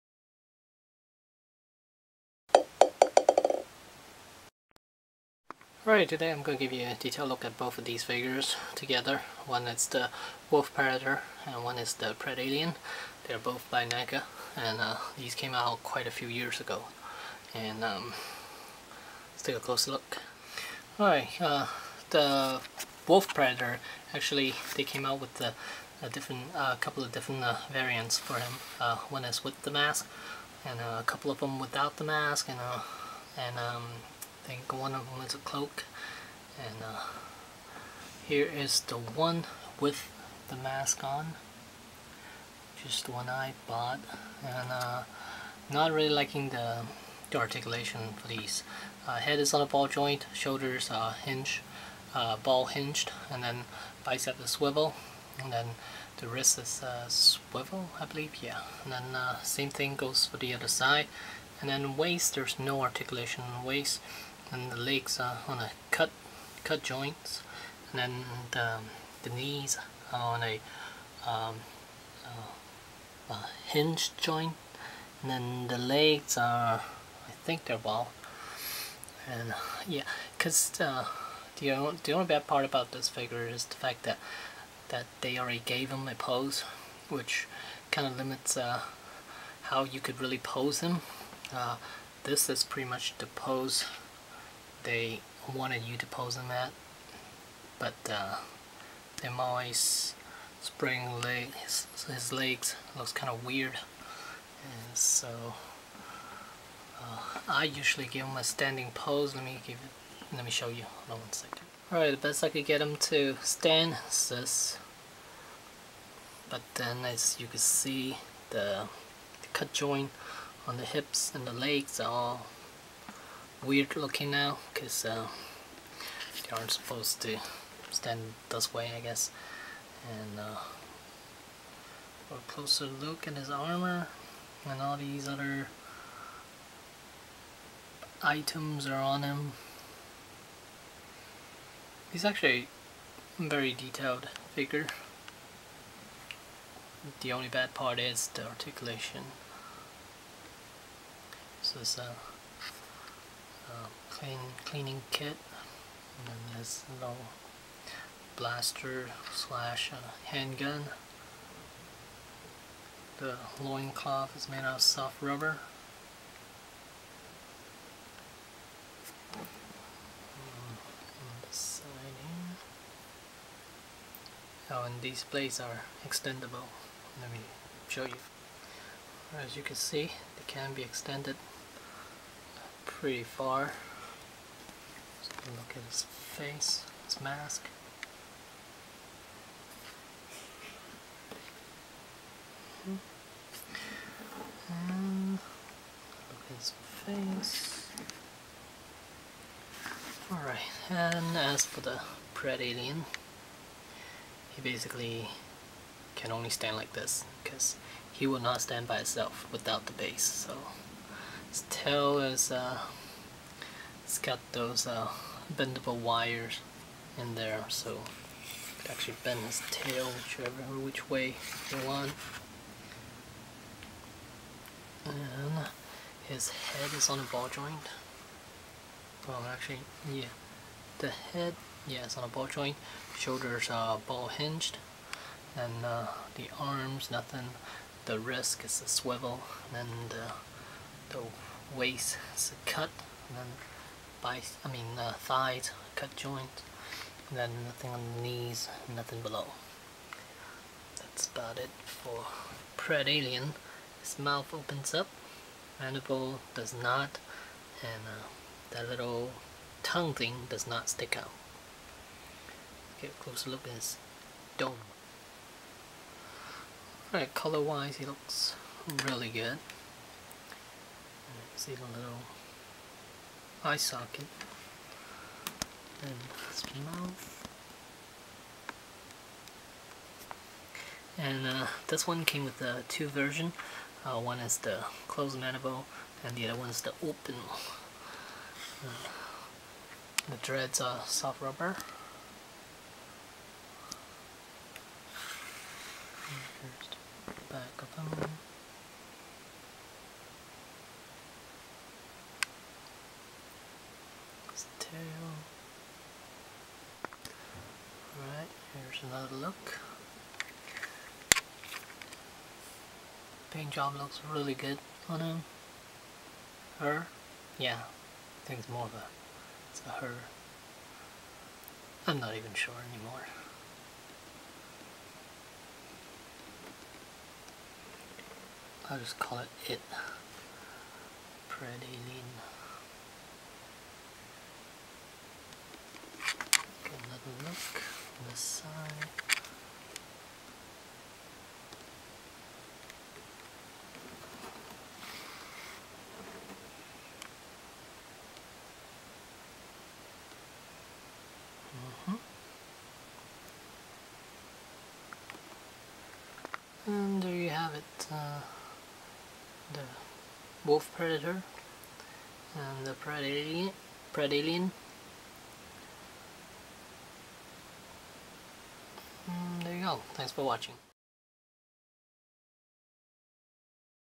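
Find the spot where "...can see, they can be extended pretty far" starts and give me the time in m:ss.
2:59.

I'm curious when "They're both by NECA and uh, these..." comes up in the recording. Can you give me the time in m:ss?
0:13.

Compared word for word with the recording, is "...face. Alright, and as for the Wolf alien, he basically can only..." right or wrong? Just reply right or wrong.
wrong.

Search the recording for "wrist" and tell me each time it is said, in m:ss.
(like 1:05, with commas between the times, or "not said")
0:56, 3:58.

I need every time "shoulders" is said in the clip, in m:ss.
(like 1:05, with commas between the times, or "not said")
0:50, 3:53.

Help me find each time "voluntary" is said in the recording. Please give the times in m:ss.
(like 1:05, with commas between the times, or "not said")
not said.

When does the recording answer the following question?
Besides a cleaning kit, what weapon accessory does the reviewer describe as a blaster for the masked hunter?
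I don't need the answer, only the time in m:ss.
2:40.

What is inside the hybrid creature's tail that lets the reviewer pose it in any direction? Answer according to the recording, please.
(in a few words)
Bendable wires.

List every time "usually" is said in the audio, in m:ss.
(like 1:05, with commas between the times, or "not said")
1:47.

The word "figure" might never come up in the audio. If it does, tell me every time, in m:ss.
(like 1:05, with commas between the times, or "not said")
0:08, 1:23, 2:24.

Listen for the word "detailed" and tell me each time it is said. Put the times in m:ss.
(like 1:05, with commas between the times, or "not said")
0:06, 2:23.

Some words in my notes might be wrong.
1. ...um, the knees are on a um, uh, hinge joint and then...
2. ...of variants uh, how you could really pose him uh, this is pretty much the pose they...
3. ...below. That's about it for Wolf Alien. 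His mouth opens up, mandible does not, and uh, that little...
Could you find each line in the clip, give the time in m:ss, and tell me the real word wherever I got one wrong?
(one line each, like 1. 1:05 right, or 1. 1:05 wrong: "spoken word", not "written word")
1. 1:08 right
2. 1:28 wrong: "limits", not "variants"
3. 4:09 wrong: "Pred", not "Wolf".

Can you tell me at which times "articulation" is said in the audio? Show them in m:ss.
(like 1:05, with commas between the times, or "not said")
0:47, 1:02, 2:28.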